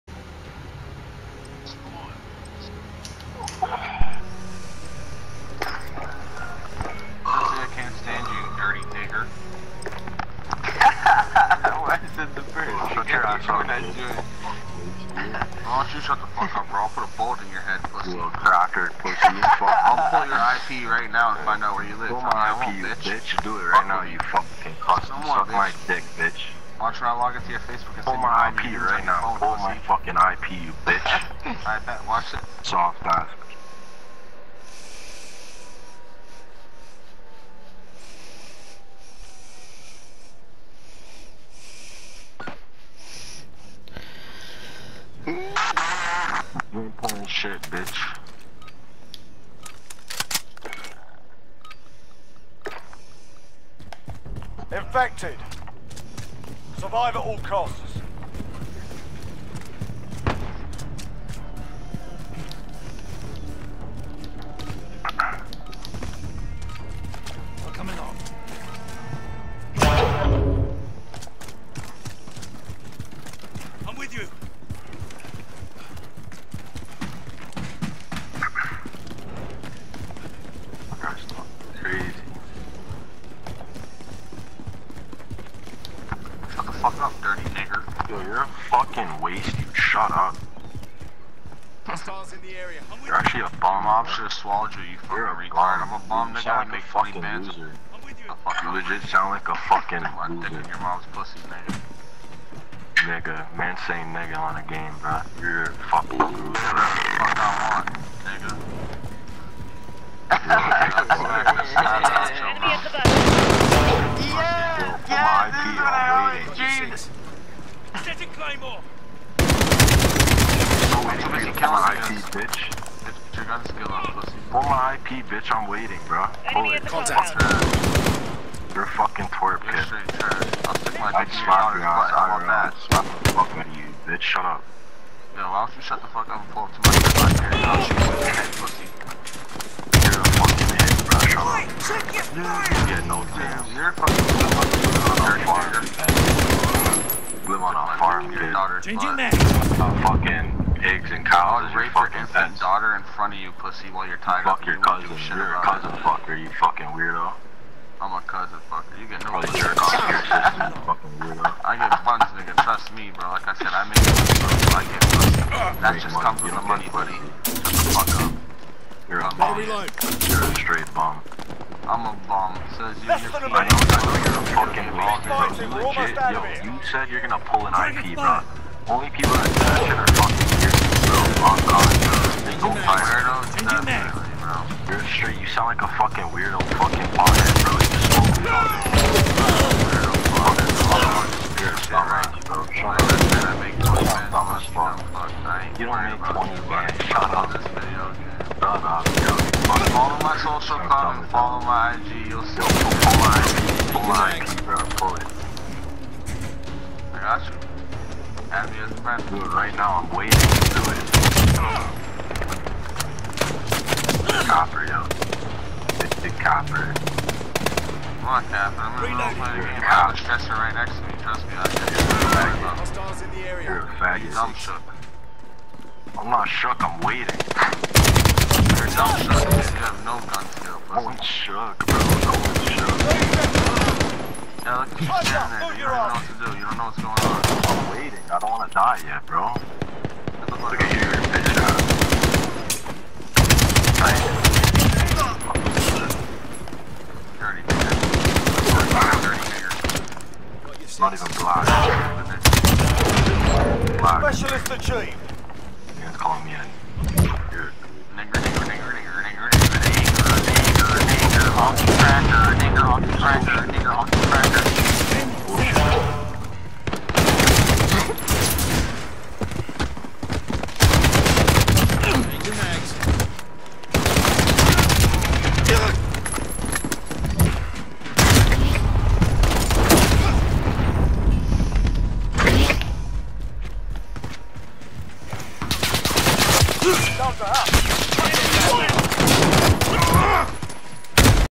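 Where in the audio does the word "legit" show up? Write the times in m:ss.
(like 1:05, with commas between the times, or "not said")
1:38, 2:55.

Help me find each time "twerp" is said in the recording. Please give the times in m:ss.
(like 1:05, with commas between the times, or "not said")
2:09.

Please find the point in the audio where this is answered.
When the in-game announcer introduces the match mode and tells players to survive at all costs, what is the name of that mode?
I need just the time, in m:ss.
0:54.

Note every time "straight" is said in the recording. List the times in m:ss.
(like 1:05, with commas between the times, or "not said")
2:50, 3:05.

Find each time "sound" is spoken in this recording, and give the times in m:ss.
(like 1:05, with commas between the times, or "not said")
1:39, 3:05.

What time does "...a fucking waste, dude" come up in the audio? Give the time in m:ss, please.
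1:28.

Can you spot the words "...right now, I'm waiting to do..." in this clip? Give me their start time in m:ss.
3:29.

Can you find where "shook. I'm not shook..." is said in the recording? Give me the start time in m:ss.
3:44.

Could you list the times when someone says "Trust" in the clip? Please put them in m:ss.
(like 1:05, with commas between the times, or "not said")
2:42, 3:41.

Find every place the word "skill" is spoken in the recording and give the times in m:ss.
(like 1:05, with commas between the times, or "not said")
3:51.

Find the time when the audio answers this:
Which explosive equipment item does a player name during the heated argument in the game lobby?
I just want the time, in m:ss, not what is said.
1:58.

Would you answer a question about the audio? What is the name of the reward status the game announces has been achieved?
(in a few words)
Specialist.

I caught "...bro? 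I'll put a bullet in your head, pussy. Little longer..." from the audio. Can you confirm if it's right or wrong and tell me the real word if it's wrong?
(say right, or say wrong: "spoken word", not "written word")
wrong: "cracker", not "longer".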